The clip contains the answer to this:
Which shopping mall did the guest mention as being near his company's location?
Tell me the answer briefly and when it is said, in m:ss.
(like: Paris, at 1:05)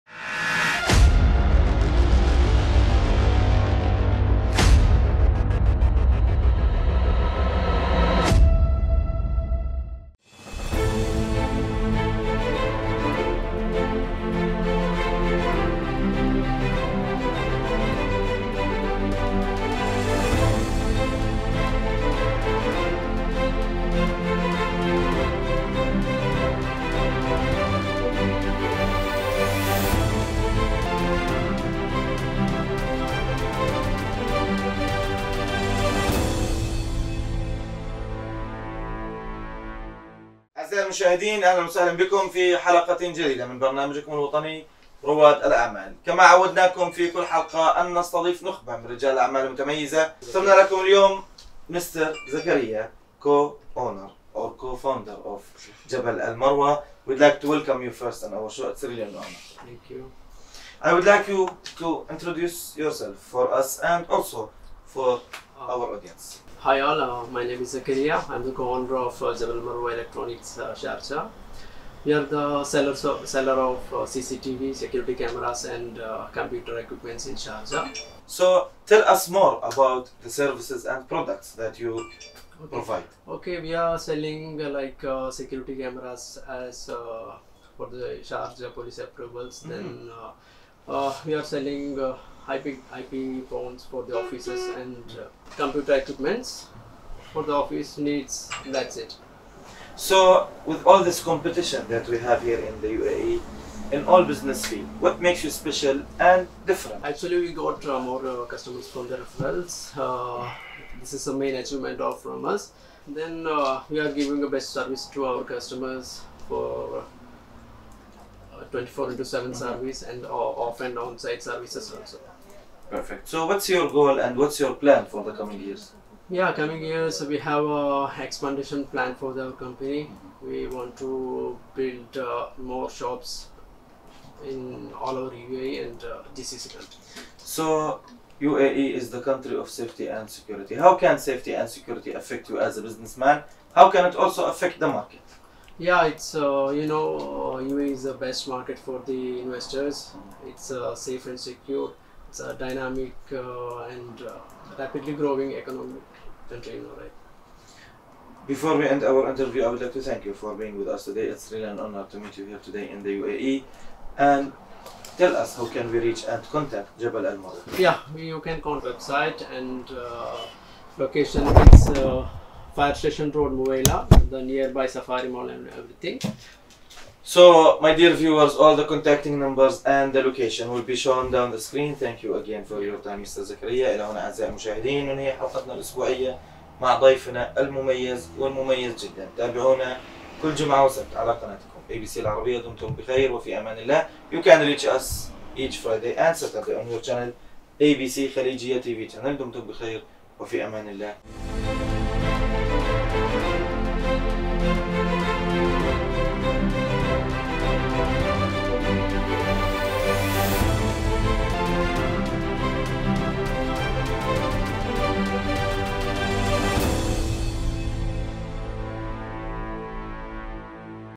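Safari Mall, at 2:54.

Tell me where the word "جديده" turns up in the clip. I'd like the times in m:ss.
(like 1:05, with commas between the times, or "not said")
0:43.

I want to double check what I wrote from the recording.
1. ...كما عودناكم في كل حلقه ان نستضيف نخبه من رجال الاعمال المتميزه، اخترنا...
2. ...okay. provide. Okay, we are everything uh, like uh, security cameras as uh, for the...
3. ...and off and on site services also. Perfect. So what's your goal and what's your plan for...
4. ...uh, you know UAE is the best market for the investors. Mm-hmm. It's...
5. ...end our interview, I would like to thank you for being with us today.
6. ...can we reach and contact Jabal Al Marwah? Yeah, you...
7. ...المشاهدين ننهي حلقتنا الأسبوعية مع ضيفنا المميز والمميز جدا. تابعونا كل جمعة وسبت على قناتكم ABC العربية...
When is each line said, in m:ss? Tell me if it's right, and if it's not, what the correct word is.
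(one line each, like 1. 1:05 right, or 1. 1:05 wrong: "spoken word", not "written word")
1. 0:46 right
2. 1:21 wrong: "selling", not "everything"
3. 2:00 right
4. 2:26 right
5. 2:38 right
6. 2:45 right
7. 3:04 right.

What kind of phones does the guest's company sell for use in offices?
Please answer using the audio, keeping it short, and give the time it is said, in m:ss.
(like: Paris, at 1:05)
IP phones, at 1:32.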